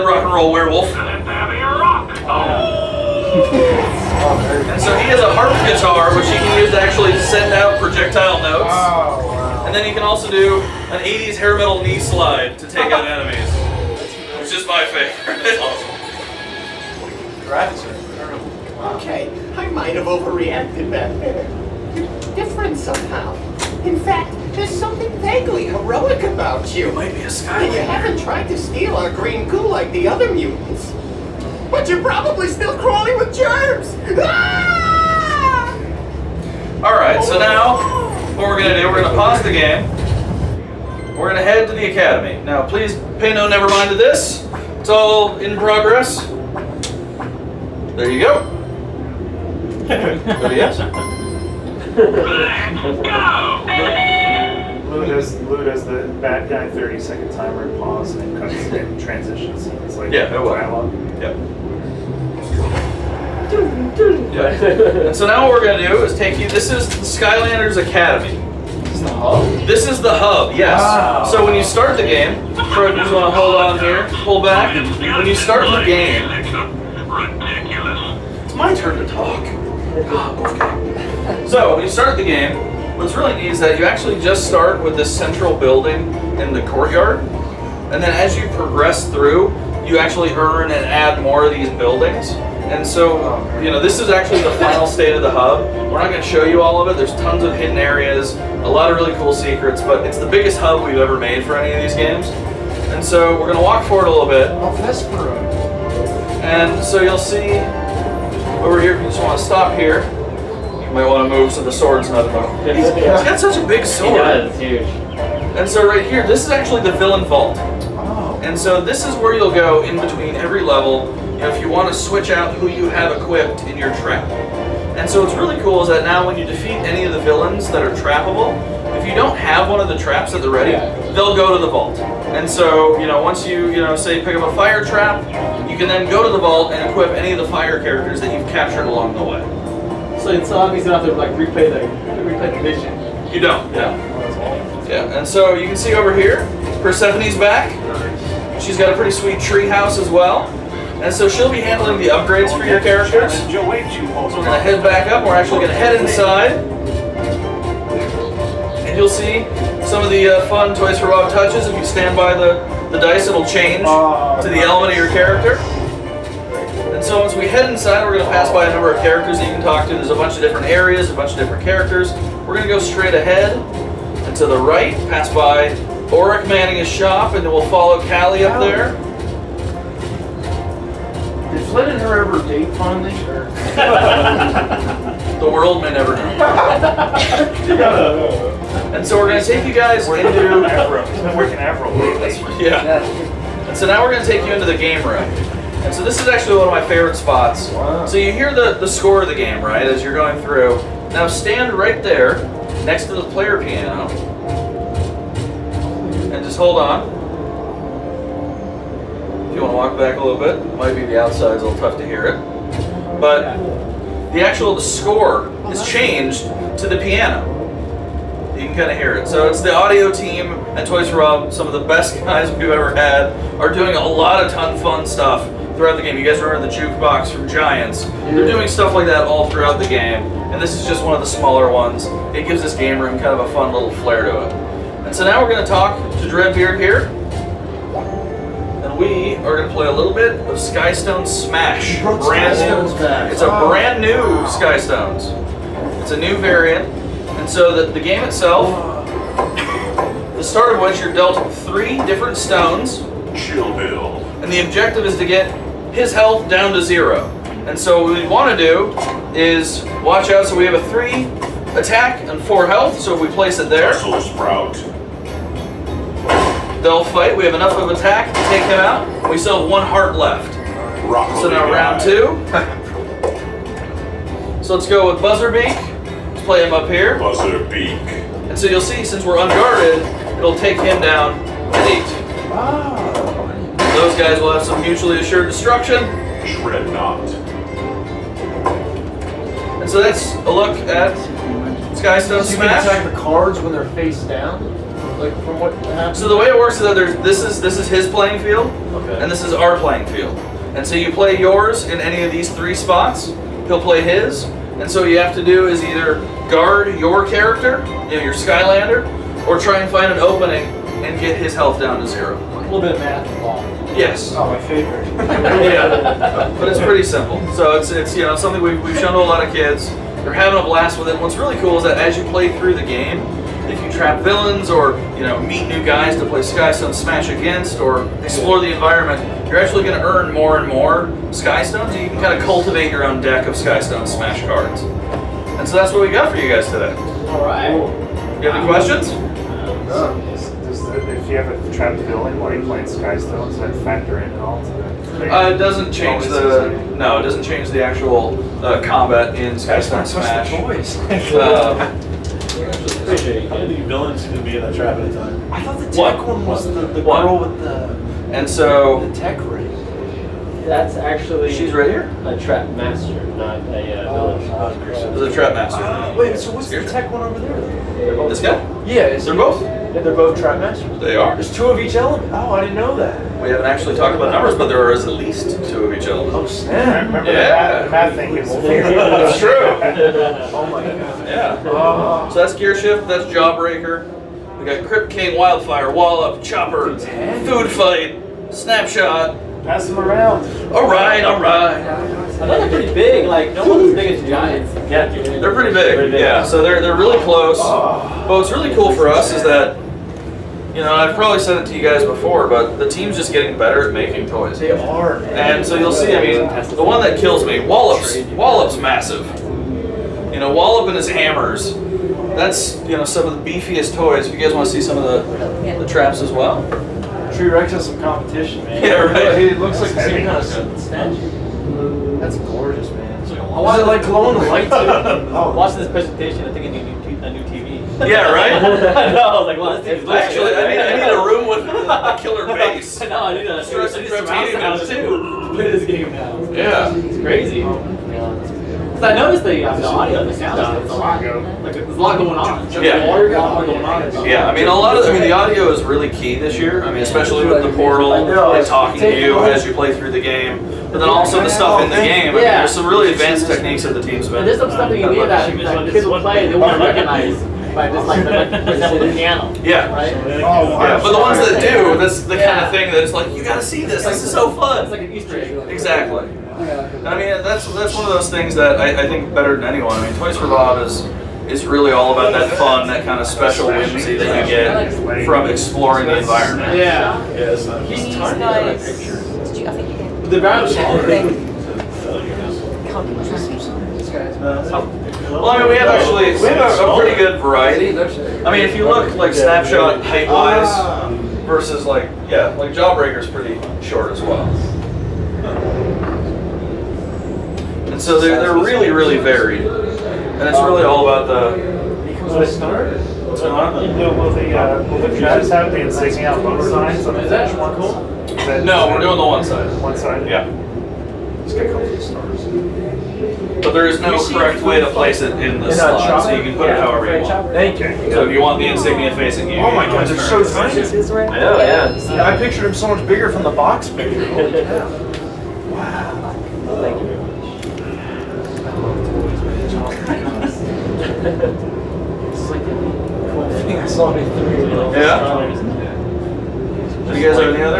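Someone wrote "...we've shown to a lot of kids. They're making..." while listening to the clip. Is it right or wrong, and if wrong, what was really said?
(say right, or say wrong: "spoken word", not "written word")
wrong: "having", not "making".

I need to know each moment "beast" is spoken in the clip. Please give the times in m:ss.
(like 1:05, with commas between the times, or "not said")
not said.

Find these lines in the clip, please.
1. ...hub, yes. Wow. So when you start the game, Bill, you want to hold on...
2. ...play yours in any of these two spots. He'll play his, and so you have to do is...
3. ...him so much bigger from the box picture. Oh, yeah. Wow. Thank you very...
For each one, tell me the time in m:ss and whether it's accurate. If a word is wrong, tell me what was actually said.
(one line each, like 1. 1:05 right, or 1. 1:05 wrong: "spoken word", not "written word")
1. 1:10 wrong: "Fred", not "Bill"
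2. 5:01 wrong: "three", not "two"
3. 8:42 right.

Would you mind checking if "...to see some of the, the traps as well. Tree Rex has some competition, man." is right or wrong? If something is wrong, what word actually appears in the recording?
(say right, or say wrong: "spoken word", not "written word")
right.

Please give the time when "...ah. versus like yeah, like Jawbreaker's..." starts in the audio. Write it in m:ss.
8:10.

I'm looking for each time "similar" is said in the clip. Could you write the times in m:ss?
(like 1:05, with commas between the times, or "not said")
not said.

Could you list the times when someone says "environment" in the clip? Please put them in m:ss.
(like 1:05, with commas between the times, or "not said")
5:28, 7:56.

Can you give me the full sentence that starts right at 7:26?
I mean, especially with the portal and talking to you as you play through the game.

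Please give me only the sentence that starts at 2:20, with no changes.
So it's obvious enough to like replay the replay the mission.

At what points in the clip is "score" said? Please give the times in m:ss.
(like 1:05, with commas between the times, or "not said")
3:18, 3:34.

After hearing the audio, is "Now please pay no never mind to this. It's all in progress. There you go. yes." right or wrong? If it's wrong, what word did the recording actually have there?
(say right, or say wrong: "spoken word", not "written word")
right.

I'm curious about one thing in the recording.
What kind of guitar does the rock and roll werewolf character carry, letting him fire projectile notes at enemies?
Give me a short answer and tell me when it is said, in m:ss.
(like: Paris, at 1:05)
Harp guitar, at 0:05.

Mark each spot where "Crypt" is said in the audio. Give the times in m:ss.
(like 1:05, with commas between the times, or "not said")
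6:24.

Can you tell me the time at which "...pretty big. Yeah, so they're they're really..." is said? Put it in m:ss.
6:35.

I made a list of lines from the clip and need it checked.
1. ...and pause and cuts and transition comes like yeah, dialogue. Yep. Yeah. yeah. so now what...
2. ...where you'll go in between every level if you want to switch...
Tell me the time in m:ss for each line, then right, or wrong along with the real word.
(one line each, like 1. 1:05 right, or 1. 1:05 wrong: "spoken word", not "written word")
1. 0:57 wrong: "scenes", not "comes"
2. 1:59 right.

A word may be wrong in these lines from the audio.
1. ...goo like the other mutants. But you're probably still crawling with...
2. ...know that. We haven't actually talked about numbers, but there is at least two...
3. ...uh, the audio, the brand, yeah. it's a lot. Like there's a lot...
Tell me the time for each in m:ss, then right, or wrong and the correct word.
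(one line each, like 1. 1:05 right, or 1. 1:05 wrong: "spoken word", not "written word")
1. 0:29 right
2. 6:12 right
3. 7:19 wrong: "sound", not "brand".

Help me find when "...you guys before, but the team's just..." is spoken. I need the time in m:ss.
6:41.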